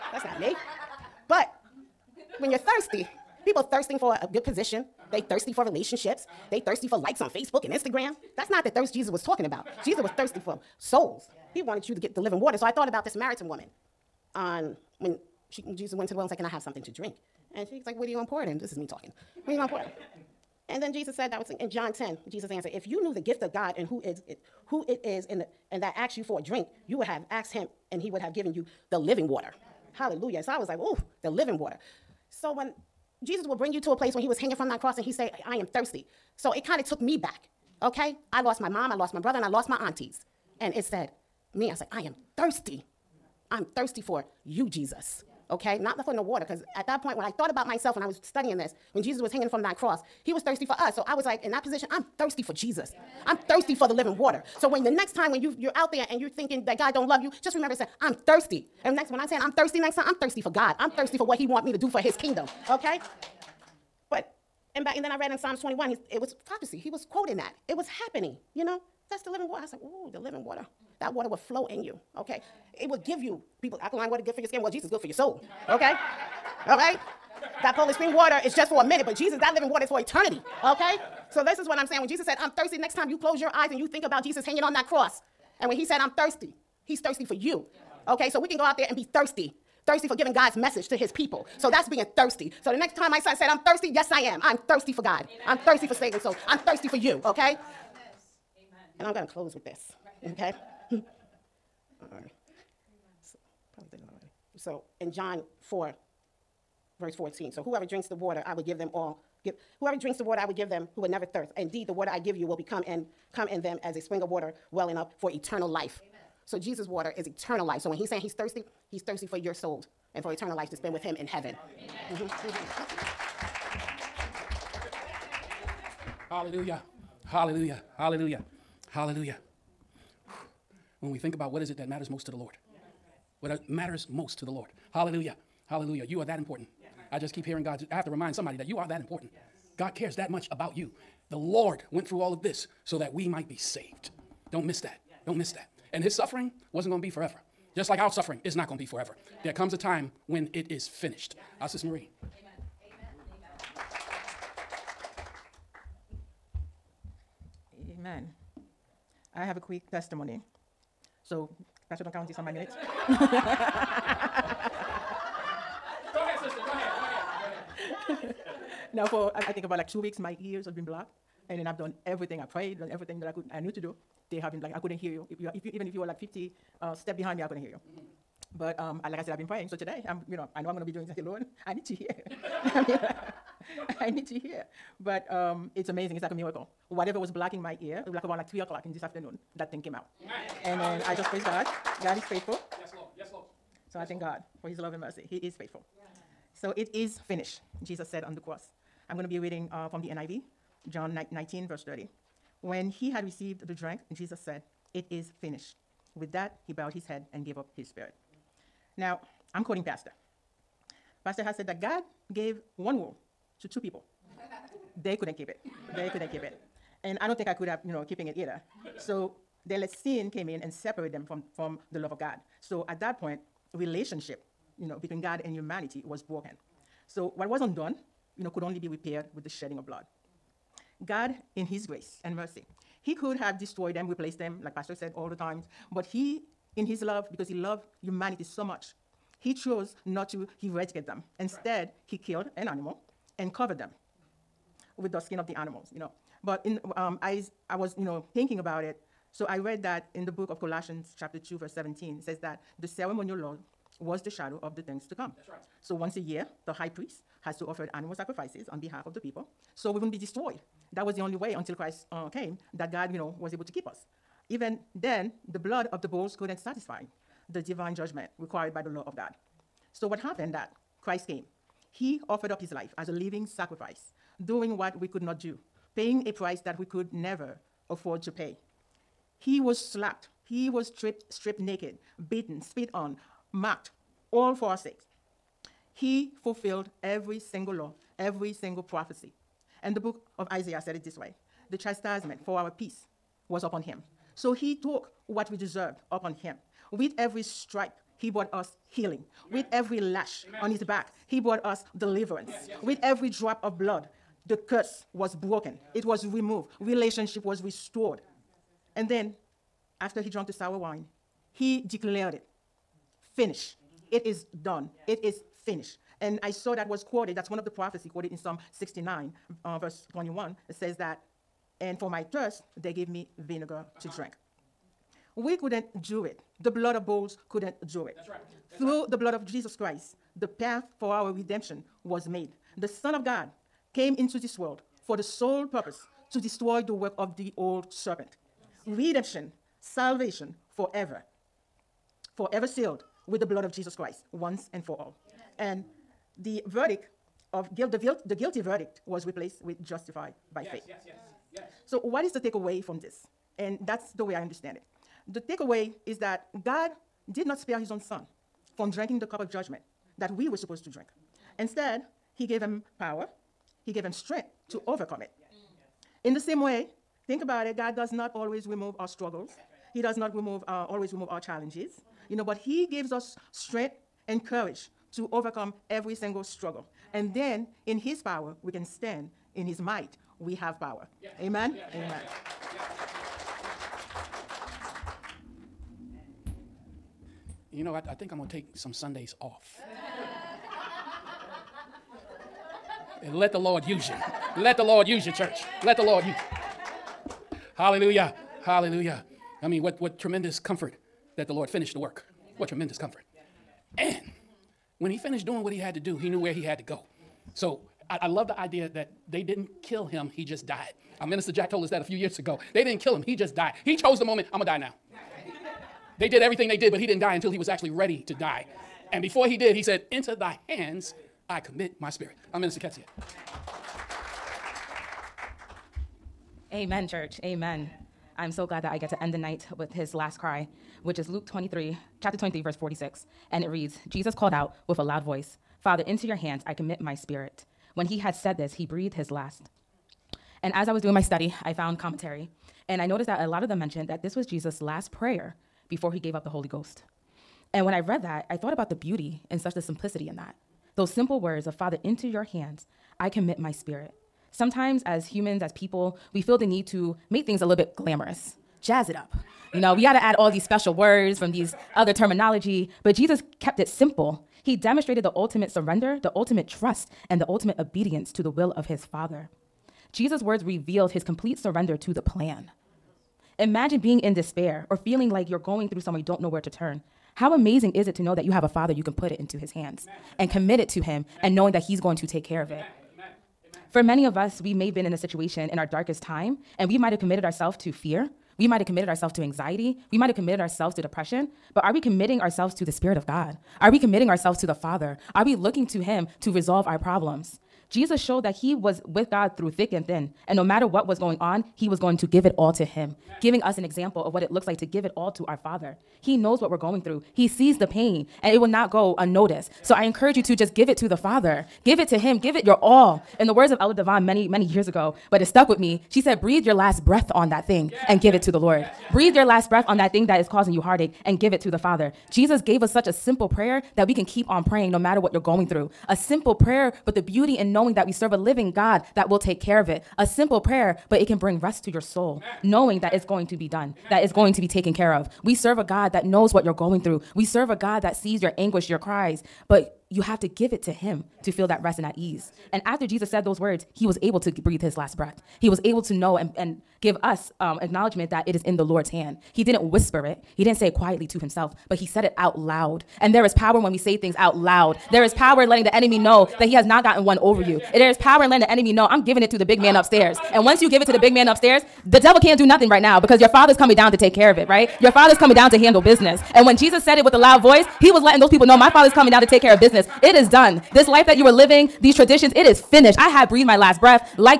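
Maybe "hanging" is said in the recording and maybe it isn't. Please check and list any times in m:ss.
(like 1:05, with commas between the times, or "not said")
0:34, 0:49, 1:24.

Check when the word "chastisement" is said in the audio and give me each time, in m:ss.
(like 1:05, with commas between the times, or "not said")
4:51.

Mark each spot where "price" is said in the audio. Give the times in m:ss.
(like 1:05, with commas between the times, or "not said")
4:36.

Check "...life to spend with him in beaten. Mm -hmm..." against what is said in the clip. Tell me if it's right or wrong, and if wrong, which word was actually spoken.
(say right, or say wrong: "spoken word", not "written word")
wrong: "heaven", not "beaten".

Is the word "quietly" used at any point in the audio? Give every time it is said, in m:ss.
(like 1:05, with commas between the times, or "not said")
9:10.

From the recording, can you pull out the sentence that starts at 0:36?
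So it kind of took me back, okay?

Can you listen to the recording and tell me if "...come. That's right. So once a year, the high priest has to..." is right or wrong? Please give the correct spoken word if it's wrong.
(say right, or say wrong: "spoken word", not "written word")
right.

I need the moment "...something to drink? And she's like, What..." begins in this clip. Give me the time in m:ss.
0:16.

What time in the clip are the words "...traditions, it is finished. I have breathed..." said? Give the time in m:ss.
9:32.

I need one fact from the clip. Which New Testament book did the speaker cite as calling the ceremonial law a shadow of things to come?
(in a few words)
Colossians.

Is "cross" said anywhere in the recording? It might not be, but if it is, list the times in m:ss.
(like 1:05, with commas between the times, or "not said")
0:34, 0:49, 1:24, 3:18.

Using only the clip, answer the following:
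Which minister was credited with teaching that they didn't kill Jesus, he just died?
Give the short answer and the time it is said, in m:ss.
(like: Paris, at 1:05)
Minister Jack, at 6:51.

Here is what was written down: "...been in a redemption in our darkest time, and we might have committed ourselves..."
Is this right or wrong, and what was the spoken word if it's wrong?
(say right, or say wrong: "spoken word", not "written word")
wrong: "situation", not "redemption".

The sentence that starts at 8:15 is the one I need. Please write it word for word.
Are we looking to Him to resolve our problems?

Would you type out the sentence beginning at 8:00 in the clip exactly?
and commit it to him Amen.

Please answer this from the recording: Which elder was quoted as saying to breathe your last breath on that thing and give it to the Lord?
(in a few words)
Elder Devon.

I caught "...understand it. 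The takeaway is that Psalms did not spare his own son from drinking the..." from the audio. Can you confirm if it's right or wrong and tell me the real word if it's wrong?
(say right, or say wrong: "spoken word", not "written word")
wrong: "God", not "Psalms".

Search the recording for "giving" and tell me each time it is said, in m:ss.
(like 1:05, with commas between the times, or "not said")
1:30, 8:23, 9:19.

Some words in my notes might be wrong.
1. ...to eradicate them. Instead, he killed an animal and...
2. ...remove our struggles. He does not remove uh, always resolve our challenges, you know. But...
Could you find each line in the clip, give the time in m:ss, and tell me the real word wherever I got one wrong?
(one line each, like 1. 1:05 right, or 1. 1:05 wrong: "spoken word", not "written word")
1. 4:00 right
2. 6:08 wrong: "remove", not "resolve".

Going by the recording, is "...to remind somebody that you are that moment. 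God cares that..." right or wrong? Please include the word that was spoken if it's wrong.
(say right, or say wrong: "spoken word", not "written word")
wrong: "important", not "moment".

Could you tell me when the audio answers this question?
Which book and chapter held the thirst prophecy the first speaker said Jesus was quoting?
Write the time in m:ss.
1:05.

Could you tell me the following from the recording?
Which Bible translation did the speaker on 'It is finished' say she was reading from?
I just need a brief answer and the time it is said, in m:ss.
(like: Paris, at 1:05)
NIV, at 3:20.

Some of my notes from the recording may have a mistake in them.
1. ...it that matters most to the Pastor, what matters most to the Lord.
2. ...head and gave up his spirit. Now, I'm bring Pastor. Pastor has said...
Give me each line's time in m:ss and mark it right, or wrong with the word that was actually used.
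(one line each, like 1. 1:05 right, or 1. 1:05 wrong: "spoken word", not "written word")
1. 2:11 wrong: "Lord", not "Pastor"
2. 3:27 wrong: "quoting", not "bring".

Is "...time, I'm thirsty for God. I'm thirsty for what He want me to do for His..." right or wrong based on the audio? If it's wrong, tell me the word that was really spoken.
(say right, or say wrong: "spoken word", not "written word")
right.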